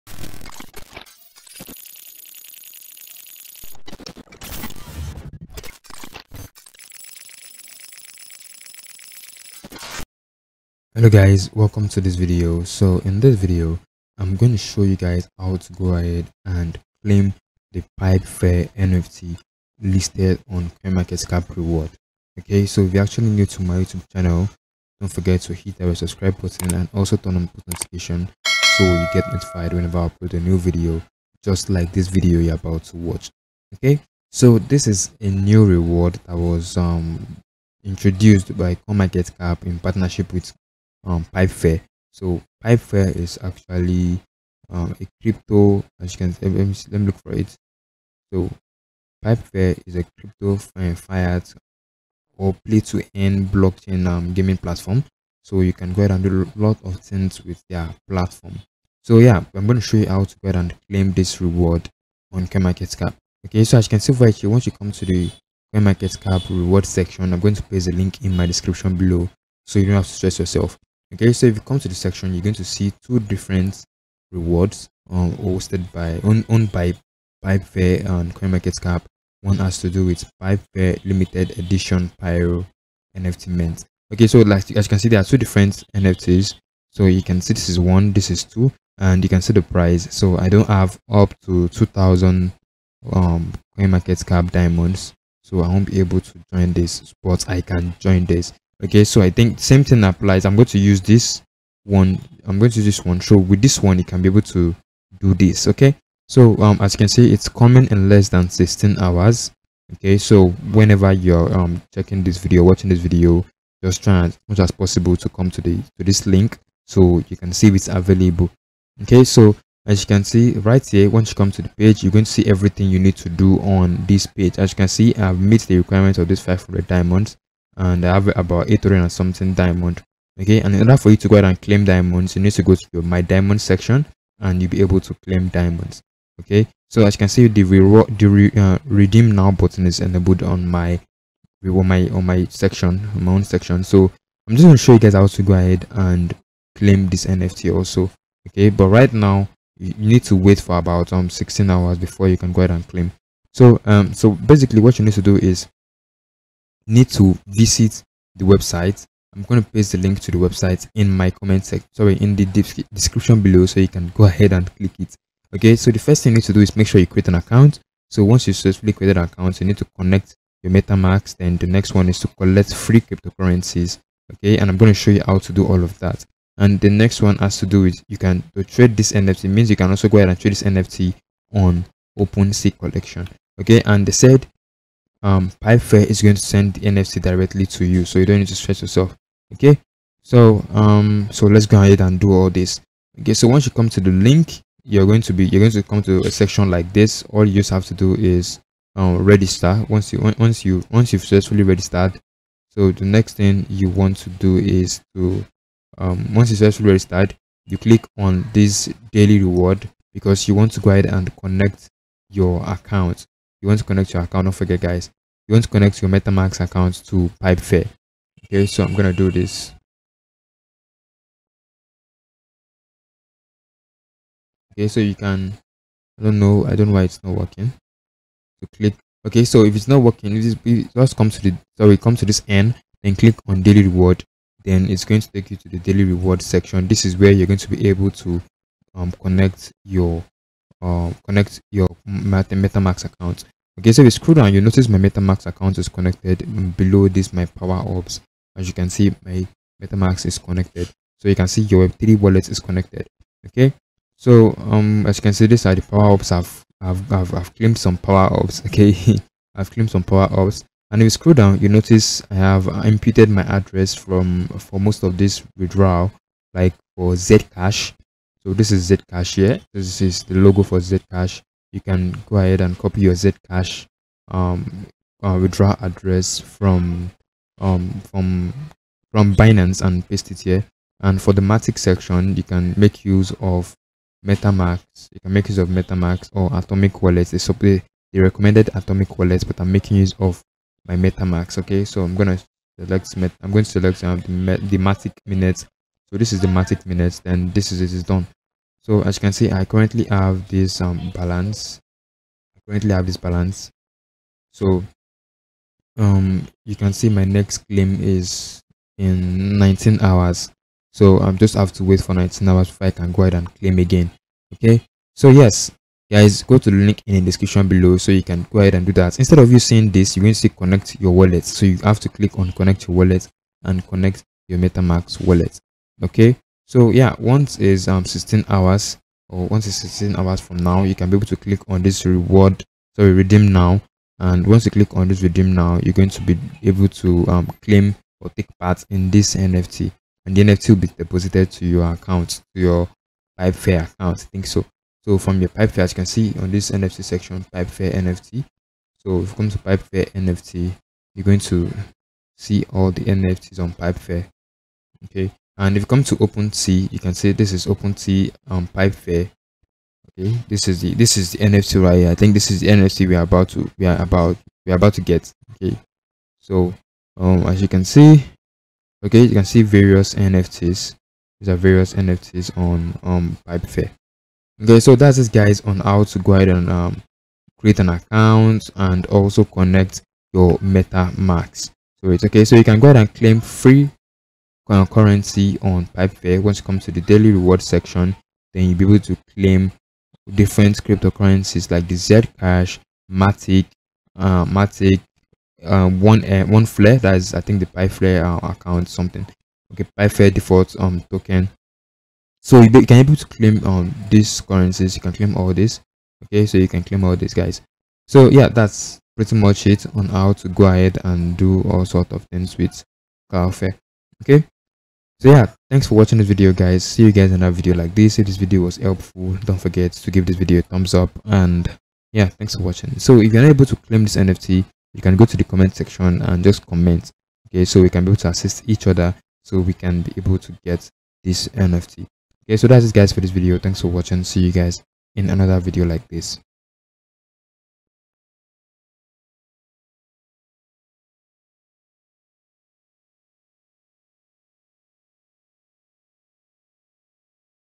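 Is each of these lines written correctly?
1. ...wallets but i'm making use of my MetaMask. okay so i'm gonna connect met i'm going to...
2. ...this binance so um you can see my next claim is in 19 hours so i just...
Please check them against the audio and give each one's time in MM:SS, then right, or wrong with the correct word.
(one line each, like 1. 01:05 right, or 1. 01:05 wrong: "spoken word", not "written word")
1. 04:49 wrong: "select", not "connect"
2. 05:03 wrong: "balance", not "binance".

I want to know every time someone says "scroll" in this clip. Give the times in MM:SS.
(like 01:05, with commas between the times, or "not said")
04:04, 04:21.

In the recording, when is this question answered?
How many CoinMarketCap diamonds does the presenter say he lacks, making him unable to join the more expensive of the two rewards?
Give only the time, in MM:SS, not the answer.
01:31.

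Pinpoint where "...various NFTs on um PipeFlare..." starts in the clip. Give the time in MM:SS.
06:11.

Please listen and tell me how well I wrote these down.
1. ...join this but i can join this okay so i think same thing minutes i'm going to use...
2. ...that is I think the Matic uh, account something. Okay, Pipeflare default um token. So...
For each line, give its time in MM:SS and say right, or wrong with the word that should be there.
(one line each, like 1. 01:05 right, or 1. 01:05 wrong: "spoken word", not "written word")
1. 01:36 wrong: "applies", not "minutes"
2. 06:36 wrong: "Pipeflare", not "Matic".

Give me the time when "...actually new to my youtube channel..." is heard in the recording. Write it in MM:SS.
00:23.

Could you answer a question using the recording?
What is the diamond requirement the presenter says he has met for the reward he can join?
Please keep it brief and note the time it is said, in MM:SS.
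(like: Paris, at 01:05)
500 diamonds, at 02:06.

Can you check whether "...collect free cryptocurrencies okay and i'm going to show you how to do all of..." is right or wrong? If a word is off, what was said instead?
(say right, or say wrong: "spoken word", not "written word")
right.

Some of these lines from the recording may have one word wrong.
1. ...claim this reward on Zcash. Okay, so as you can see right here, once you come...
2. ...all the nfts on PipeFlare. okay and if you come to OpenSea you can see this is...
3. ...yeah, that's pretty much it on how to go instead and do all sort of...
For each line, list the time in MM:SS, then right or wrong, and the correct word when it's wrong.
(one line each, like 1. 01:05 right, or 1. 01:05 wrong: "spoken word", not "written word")
1. 01:00 wrong: "CoinMarketCap", not "Zcash"
2. 05:52 right
3. 06:48 wrong: "ahead", not "instead".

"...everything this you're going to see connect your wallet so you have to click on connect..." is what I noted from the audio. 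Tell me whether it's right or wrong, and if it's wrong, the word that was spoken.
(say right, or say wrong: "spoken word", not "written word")
wrong: "seeing", not "everything".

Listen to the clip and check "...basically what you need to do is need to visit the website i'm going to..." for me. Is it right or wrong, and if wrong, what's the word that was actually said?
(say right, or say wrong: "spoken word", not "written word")
right.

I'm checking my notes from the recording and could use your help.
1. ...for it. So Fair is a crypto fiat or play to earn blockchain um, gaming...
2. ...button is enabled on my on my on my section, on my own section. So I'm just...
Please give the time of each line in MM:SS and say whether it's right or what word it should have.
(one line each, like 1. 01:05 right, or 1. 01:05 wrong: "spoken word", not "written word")
1. 00:47 right
2. 02:19 right.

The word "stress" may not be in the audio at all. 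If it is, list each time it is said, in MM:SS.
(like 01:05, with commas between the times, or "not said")
01:10, 03:08.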